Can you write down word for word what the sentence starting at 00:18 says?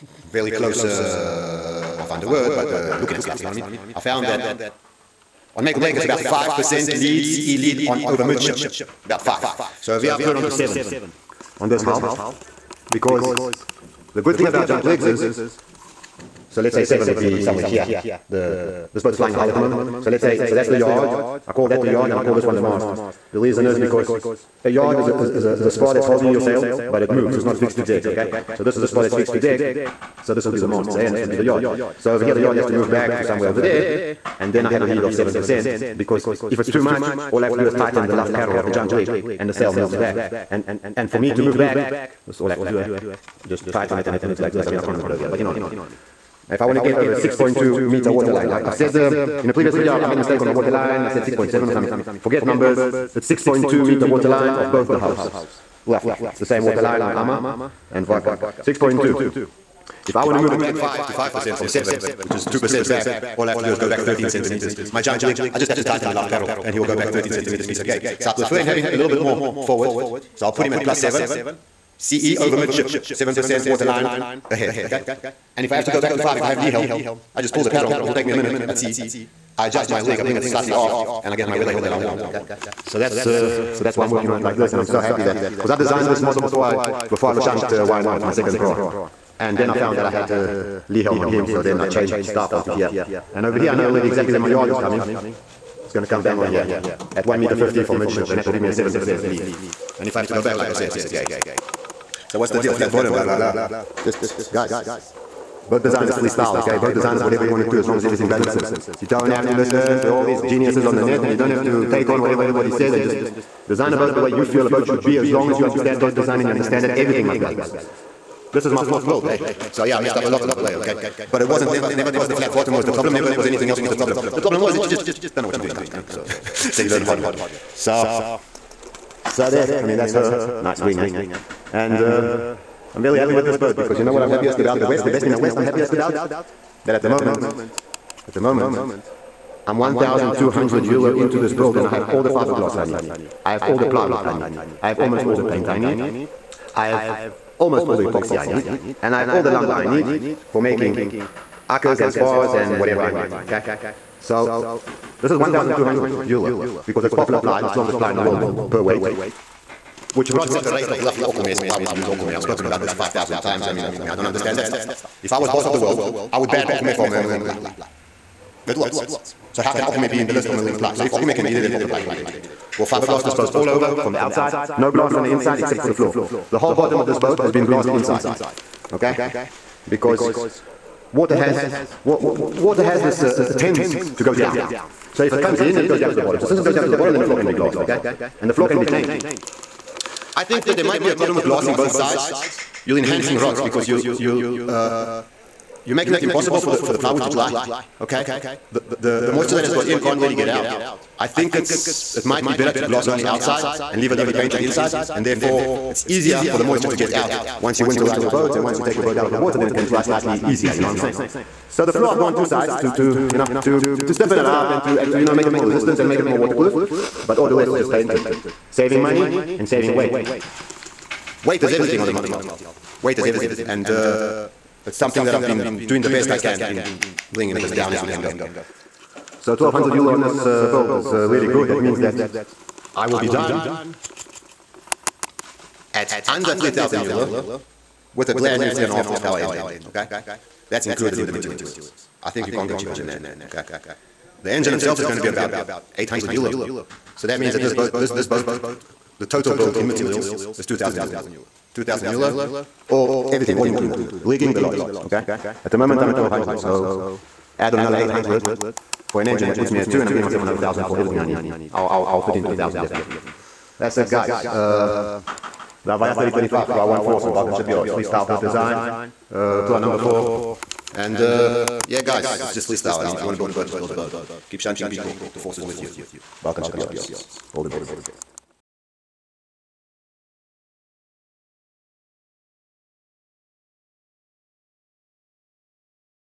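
The This boat's flying a hull at the moment.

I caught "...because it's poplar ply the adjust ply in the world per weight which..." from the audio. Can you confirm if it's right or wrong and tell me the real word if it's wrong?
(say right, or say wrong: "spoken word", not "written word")
wrong: "strongest", not "adjust".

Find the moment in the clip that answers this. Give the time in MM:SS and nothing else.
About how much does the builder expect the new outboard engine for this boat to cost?
04:05.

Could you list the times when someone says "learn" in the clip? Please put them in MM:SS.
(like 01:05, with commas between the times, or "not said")
02:06.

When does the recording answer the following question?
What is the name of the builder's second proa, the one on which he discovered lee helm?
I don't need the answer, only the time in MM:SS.
01:27.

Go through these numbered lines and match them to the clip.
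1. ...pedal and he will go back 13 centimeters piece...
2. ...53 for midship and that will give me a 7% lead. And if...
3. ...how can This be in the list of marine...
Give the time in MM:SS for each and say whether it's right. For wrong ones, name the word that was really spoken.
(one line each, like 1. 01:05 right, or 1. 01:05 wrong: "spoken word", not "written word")
1. 01:06 right
2. 01:37 wrong: "50", not "53"
3. 02:49 wrong: "Okume", not "This".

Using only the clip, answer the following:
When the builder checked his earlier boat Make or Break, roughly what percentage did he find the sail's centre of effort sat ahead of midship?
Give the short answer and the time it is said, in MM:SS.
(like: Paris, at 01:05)
5%, at 00:06.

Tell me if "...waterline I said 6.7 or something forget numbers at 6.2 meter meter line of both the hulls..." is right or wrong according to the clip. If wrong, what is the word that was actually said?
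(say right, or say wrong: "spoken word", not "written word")
wrong: "water", not "meter".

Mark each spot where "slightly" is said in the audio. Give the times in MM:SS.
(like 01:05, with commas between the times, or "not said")
01:20, 03:30.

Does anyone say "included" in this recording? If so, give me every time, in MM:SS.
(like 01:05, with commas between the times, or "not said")
04:00, 04:13.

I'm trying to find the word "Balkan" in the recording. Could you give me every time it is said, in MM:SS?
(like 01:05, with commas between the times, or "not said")
04:27, 04:36.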